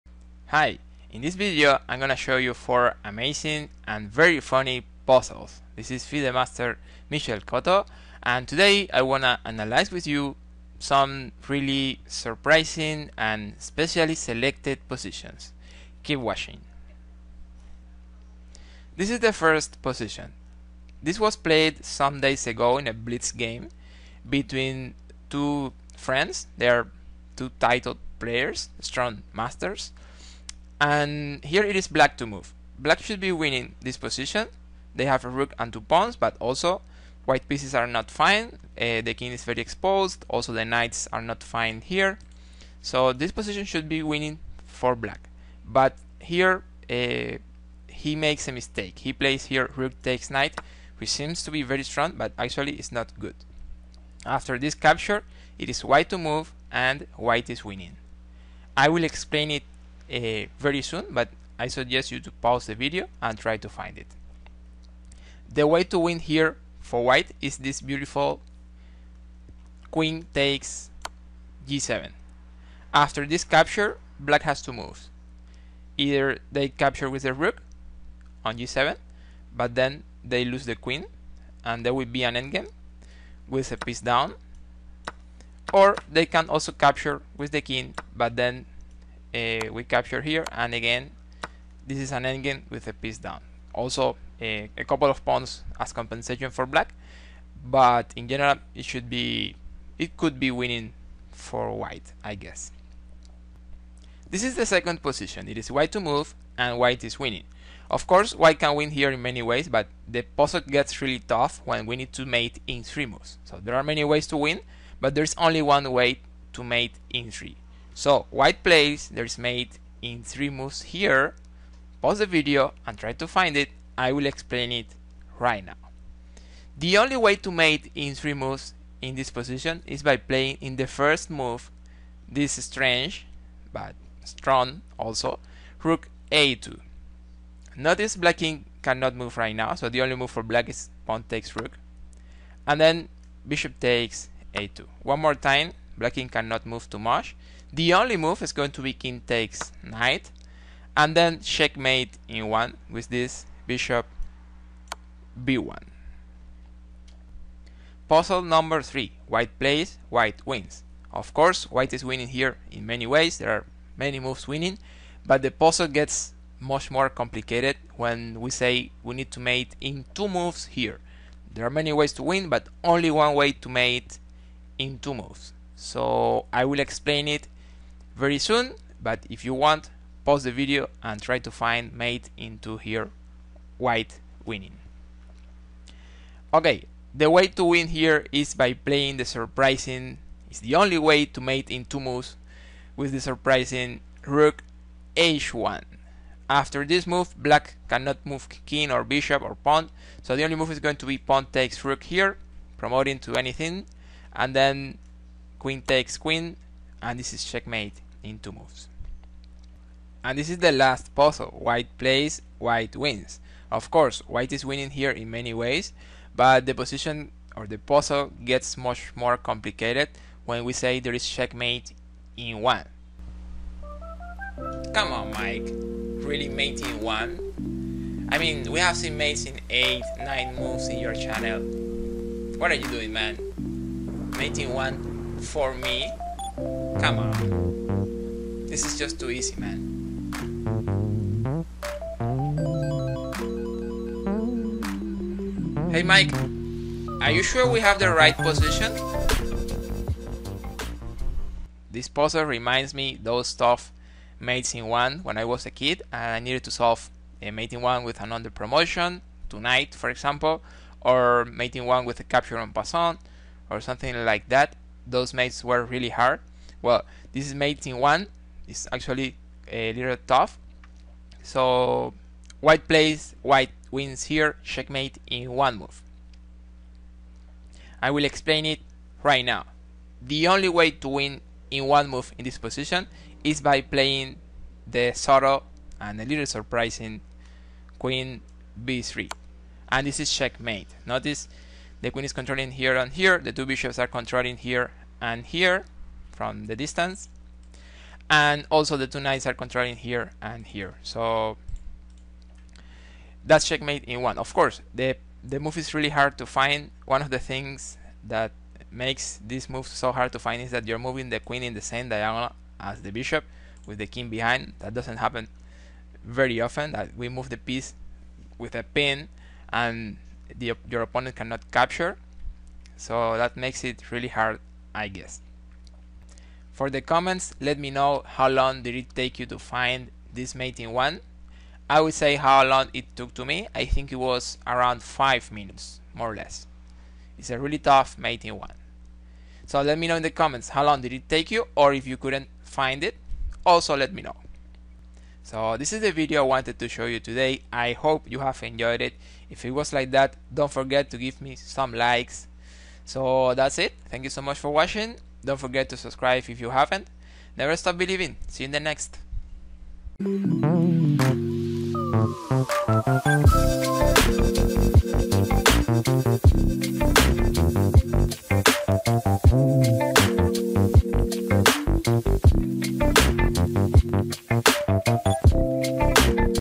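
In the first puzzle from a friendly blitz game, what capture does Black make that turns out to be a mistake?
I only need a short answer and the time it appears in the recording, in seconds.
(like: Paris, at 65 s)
rook takes knight, at 49 s.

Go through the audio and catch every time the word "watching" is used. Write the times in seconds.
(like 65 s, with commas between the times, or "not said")
16 s, 354 s.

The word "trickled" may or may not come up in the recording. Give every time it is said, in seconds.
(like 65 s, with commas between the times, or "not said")
not said.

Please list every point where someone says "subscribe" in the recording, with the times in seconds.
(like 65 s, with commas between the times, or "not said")
355 s.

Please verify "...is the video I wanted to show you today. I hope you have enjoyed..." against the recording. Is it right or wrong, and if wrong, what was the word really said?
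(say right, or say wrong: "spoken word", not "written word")
right.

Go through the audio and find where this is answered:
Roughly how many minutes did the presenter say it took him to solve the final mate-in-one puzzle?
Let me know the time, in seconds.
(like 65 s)
335 s.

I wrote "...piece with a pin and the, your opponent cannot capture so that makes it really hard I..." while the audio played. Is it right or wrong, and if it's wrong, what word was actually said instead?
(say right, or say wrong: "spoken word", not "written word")
right.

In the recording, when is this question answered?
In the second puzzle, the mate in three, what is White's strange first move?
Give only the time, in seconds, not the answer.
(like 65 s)
135 s.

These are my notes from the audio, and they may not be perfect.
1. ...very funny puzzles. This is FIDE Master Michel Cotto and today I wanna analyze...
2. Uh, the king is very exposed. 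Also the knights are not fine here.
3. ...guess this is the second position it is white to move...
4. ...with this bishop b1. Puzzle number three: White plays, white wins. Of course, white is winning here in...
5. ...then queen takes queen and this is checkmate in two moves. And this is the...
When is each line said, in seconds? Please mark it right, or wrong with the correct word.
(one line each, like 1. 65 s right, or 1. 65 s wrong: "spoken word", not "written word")
1. 4 s right
2. 38 s right
3. 102 s right
4. 152 s right
5. 204 s right.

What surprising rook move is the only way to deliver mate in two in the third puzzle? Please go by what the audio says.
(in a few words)
rook h1.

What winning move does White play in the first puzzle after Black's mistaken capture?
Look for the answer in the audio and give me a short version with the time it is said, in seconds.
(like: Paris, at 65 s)
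queen takes g7, at 69 s.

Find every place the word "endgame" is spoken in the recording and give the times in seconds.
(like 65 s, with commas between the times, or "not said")
82 s, 92 s.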